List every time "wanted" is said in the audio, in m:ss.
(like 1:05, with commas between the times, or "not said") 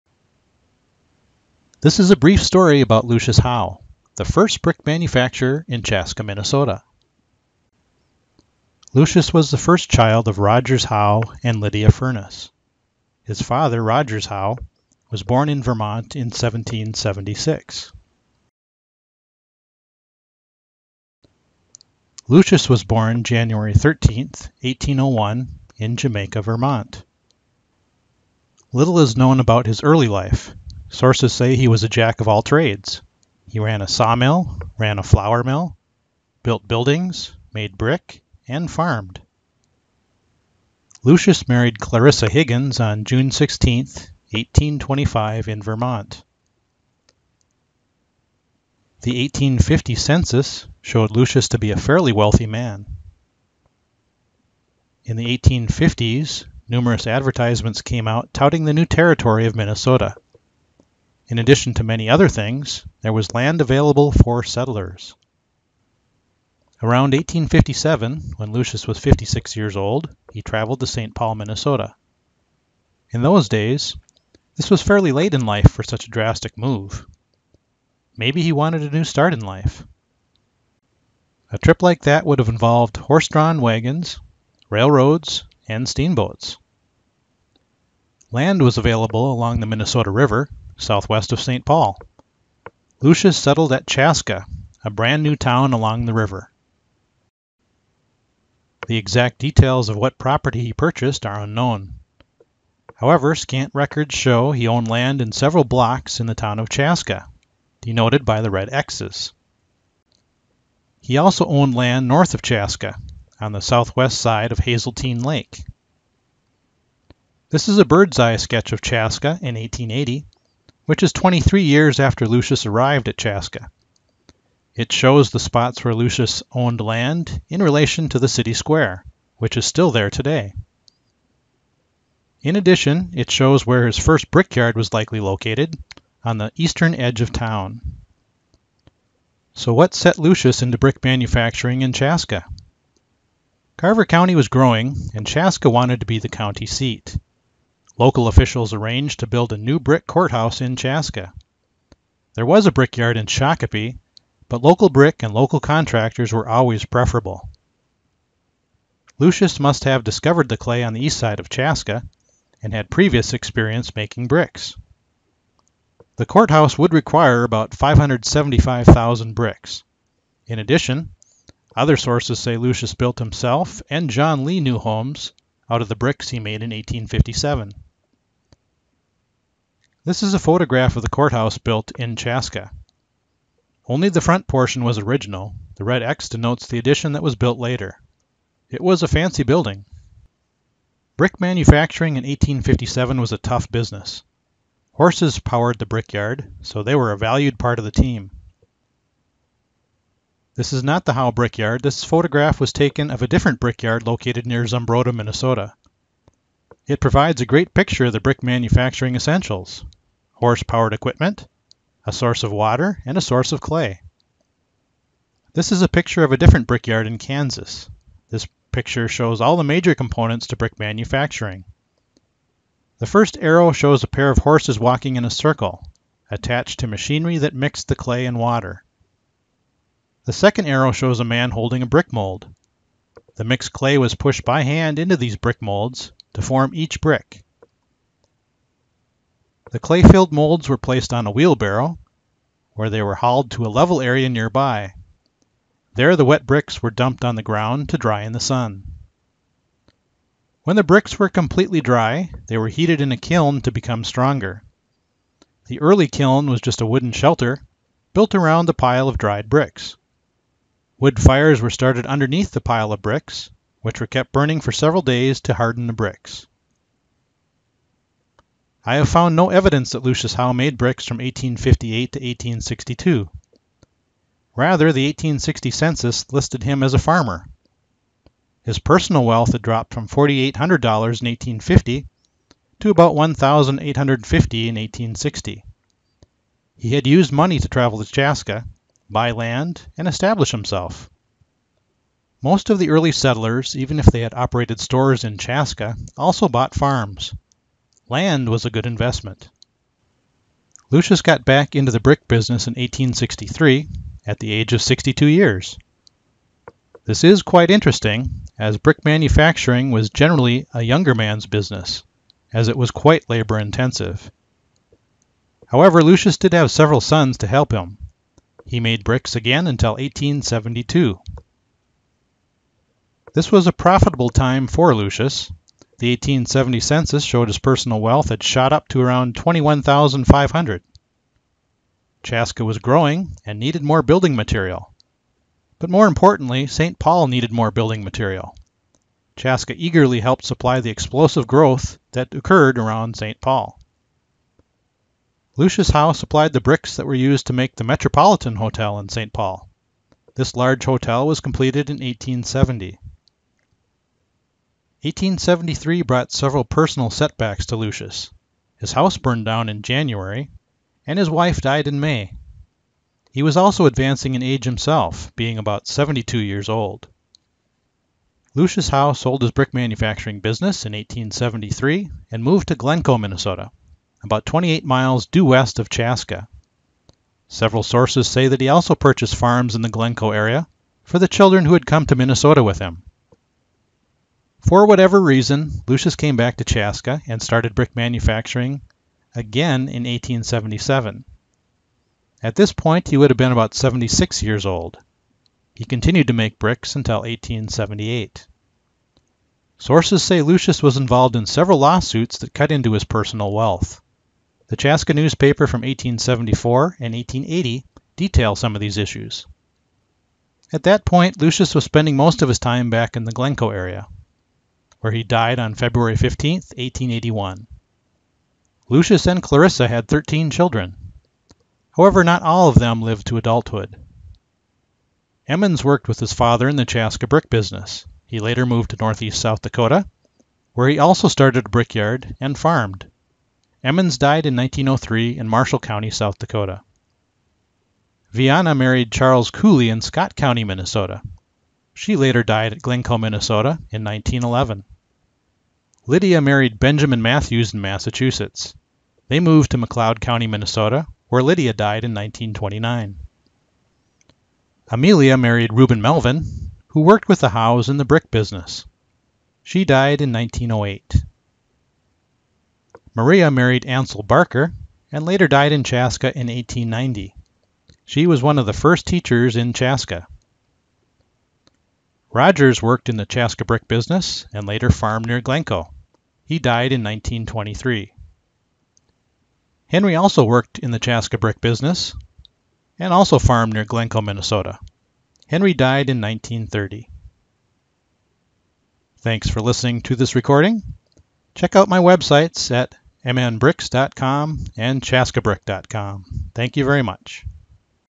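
1:18, 2:25.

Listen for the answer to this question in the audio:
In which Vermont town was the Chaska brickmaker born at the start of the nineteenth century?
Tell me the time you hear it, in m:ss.
0:25.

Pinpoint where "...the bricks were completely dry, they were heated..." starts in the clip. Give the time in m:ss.
4:10.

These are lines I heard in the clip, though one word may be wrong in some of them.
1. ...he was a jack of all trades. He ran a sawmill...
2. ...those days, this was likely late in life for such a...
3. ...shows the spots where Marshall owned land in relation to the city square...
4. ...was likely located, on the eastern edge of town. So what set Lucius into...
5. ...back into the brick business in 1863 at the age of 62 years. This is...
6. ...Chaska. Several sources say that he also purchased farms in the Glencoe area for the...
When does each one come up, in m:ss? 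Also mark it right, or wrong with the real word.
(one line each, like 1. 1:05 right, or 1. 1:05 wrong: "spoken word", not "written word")
1. 0:31 right
2. 1:13 wrong: "fairly", not "likely"
3. 2:04 wrong: "Lucius", not "Marshall"
4. 2:14 right
5. 5:01 right
6. 6:15 right.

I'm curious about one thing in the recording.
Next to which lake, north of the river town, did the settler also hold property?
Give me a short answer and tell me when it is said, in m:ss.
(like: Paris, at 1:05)
Hazeltine Lake, at 1:54.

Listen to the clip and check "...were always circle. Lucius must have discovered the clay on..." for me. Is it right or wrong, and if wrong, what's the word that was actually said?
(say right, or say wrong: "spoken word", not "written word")
wrong: "preferable", not "circle".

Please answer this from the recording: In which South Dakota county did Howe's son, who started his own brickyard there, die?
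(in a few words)
Marshall County.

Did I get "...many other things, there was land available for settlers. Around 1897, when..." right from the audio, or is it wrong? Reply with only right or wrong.
wrong.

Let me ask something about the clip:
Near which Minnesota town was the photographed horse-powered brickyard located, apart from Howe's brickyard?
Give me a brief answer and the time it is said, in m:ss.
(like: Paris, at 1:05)
Zumbrota, at 3:24.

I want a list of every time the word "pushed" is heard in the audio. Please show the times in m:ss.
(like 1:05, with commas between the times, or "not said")
3:54.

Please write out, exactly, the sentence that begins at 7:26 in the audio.
Lydia married Benjamin Matthews in Massachusetts.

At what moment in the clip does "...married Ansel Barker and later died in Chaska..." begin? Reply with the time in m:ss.
7:43.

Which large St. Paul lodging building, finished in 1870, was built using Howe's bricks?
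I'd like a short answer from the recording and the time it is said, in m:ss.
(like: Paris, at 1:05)
Metropolitan Hotel, at 5:47.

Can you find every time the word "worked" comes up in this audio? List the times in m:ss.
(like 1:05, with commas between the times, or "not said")
7:05, 7:36, 7:52, 8:00.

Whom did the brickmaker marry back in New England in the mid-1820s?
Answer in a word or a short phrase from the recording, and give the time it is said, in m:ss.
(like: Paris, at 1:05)
Clarissa Higgins, at 0:41.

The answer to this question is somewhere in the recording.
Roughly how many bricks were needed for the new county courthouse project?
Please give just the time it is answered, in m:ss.
2:47.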